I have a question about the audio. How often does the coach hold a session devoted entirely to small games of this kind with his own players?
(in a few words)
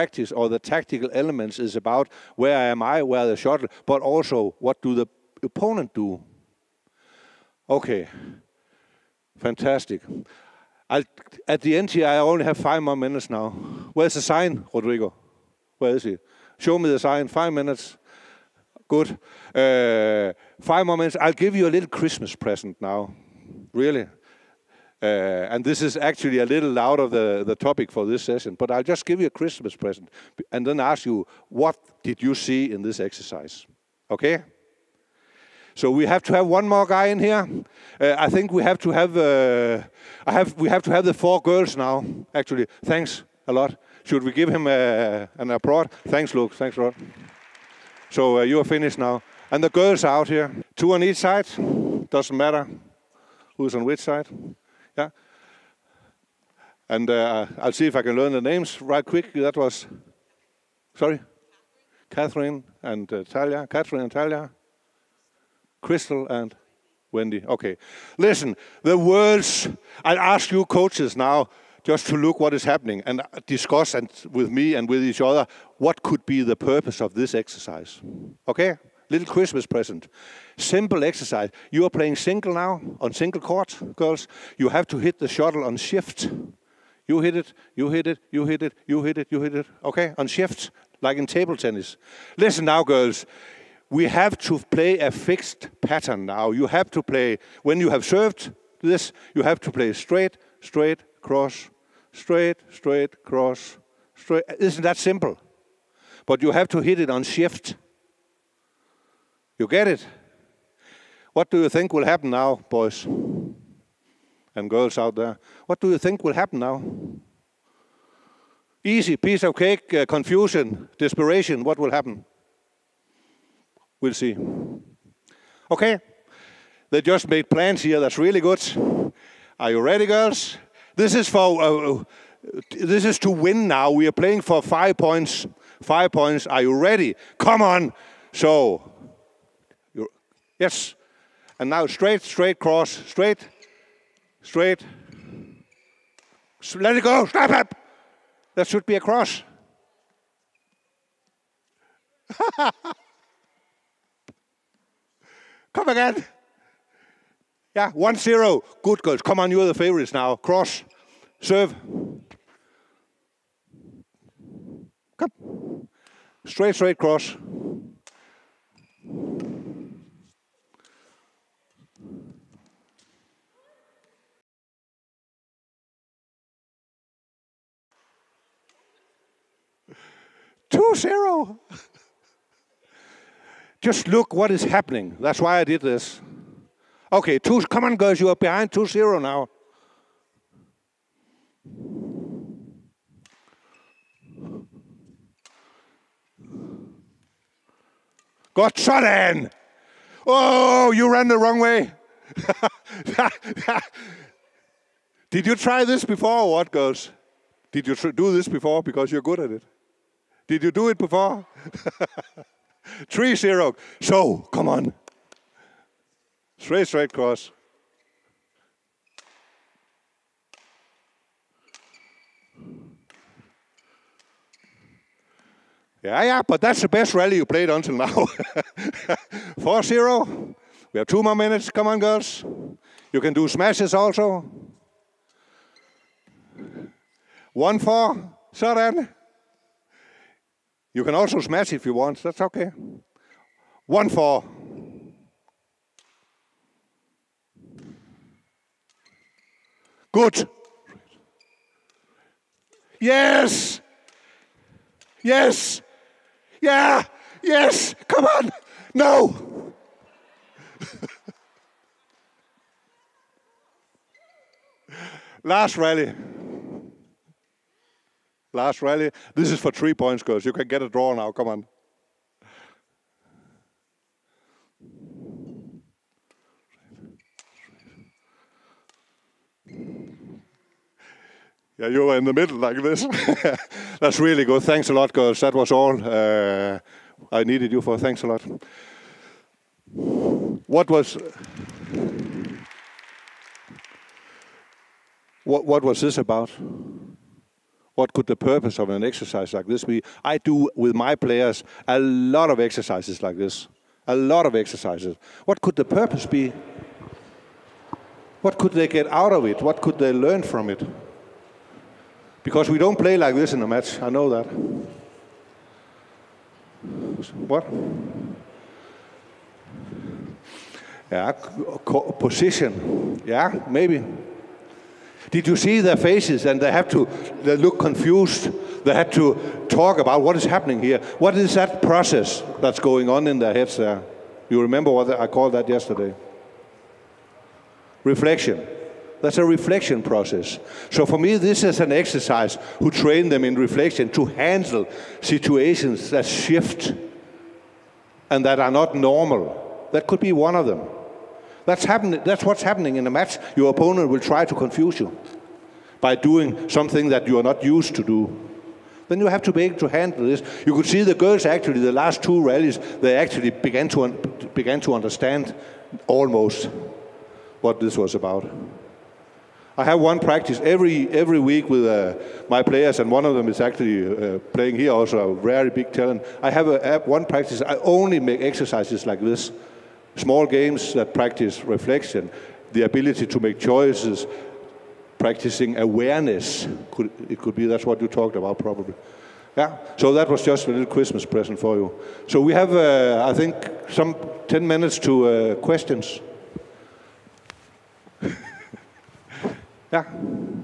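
Every week.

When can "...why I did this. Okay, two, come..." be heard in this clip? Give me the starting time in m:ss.
3:05.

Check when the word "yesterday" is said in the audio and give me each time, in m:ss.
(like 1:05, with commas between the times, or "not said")
5:35.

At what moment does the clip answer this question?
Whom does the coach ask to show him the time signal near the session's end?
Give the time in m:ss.
0:14.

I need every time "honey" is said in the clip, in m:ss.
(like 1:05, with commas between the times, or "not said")
not said.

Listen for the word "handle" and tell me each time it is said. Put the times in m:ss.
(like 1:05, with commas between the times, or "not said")
5:44, 5:59.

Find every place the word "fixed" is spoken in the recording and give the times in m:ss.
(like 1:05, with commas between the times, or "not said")
1:35.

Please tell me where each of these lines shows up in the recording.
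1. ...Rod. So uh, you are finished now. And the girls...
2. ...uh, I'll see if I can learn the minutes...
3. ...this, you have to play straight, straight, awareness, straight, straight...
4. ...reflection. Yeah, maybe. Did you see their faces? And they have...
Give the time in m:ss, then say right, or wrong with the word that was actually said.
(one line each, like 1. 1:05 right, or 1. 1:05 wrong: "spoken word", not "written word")
1. 0:46 right
2. 0:57 wrong: "names", not "minutes"
3. 1:38 wrong: "cross", not "awareness"
4. 5:22 wrong: "position", not "reflection".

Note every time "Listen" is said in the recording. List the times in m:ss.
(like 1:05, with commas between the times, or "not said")
1:08, 1:32.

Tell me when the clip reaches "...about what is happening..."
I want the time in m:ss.
5:29.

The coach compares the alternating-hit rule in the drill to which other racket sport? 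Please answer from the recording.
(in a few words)
Table tennis.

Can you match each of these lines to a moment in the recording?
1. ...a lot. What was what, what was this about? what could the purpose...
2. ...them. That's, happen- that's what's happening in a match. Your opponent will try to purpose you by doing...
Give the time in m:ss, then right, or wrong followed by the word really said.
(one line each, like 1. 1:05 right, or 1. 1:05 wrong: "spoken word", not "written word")
1. 4:48 right
2. 5:50 wrong: "confuse", not "purpose".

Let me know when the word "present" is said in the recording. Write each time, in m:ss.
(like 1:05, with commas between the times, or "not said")
0:22, 0:29, 1:19, 6:31.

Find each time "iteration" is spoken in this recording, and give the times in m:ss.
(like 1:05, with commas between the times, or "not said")
not said.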